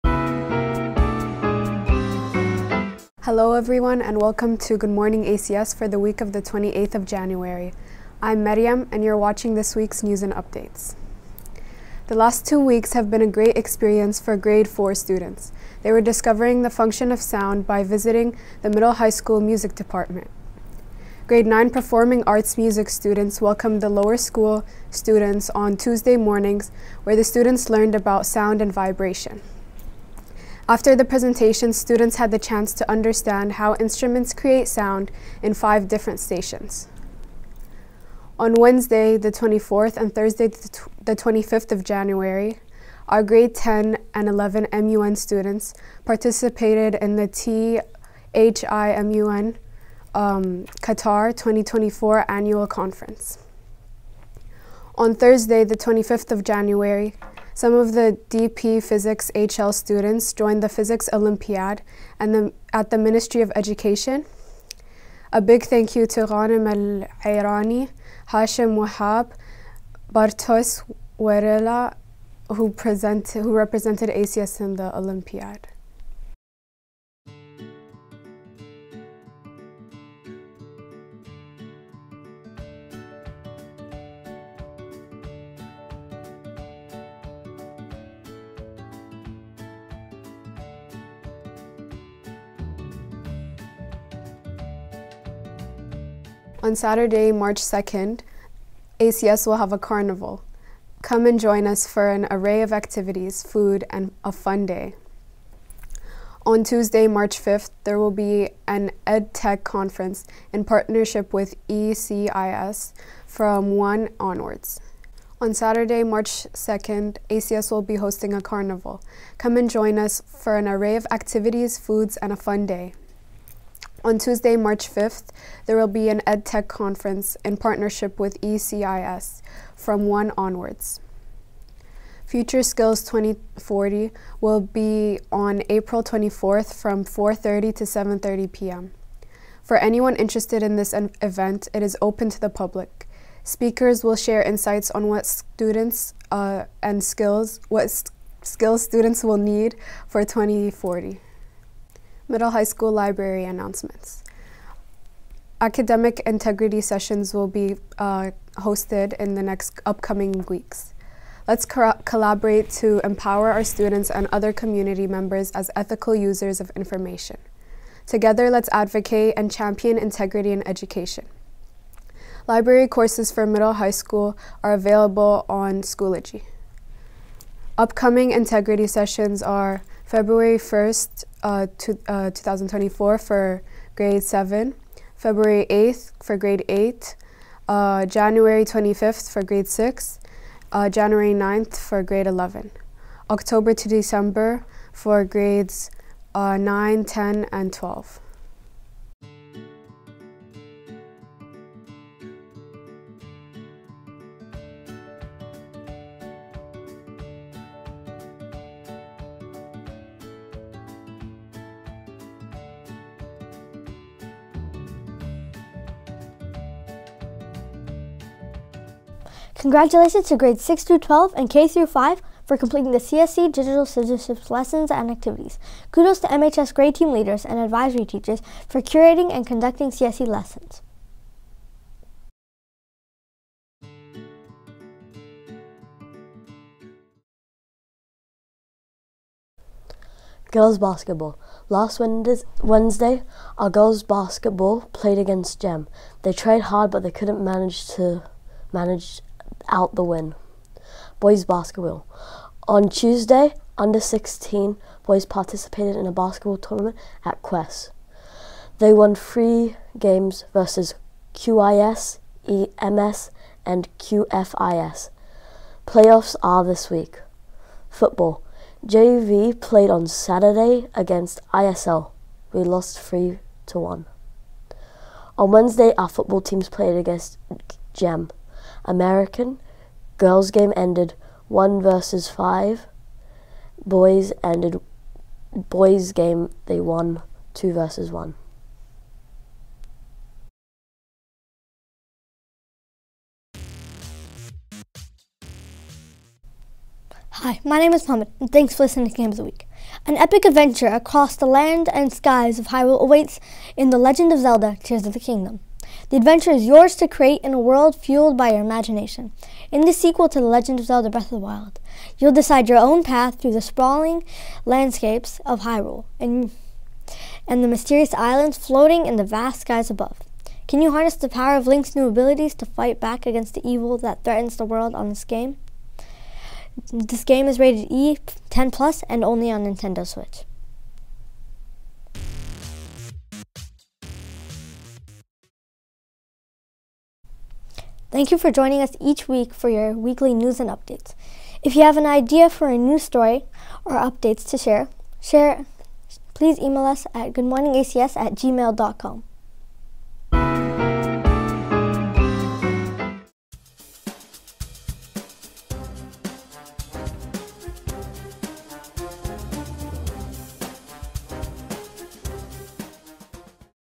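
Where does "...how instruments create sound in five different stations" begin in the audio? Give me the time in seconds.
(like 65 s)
33 s.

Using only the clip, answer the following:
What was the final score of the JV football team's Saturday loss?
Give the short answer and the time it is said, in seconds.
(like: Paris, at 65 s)
3 to 1, at 272 s.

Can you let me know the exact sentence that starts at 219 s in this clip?
Congratulations to grades 6 through 12 and K through 5 for completing the CSC Digital Citizenship lessons and activities.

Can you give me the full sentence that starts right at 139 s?
For anyone interested in this event, it is open to the public.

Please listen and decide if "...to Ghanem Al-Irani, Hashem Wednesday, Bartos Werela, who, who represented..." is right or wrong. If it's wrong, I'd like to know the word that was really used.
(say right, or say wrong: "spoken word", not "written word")
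wrong: "Wahab", not "Wednesday".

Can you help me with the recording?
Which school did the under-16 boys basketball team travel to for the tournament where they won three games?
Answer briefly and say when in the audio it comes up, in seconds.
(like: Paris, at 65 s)
Quest, at 257 s.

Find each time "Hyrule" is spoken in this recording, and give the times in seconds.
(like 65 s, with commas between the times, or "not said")
302 s, 315 s.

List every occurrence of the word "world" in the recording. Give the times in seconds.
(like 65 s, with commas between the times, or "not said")
307 s, 324 s.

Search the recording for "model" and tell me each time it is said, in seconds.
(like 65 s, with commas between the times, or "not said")
not said.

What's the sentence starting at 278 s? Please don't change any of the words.
American, girls game ended 1 versus 5.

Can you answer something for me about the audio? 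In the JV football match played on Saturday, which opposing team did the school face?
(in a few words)
ISL.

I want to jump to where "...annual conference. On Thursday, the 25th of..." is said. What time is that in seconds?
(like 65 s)
52 s.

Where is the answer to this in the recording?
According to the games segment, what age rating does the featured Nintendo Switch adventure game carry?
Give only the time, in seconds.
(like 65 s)
327 s.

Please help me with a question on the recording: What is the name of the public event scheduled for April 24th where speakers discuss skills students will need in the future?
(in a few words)
Future Skills 2040.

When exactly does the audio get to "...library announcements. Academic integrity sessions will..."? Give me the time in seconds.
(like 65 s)
152 s.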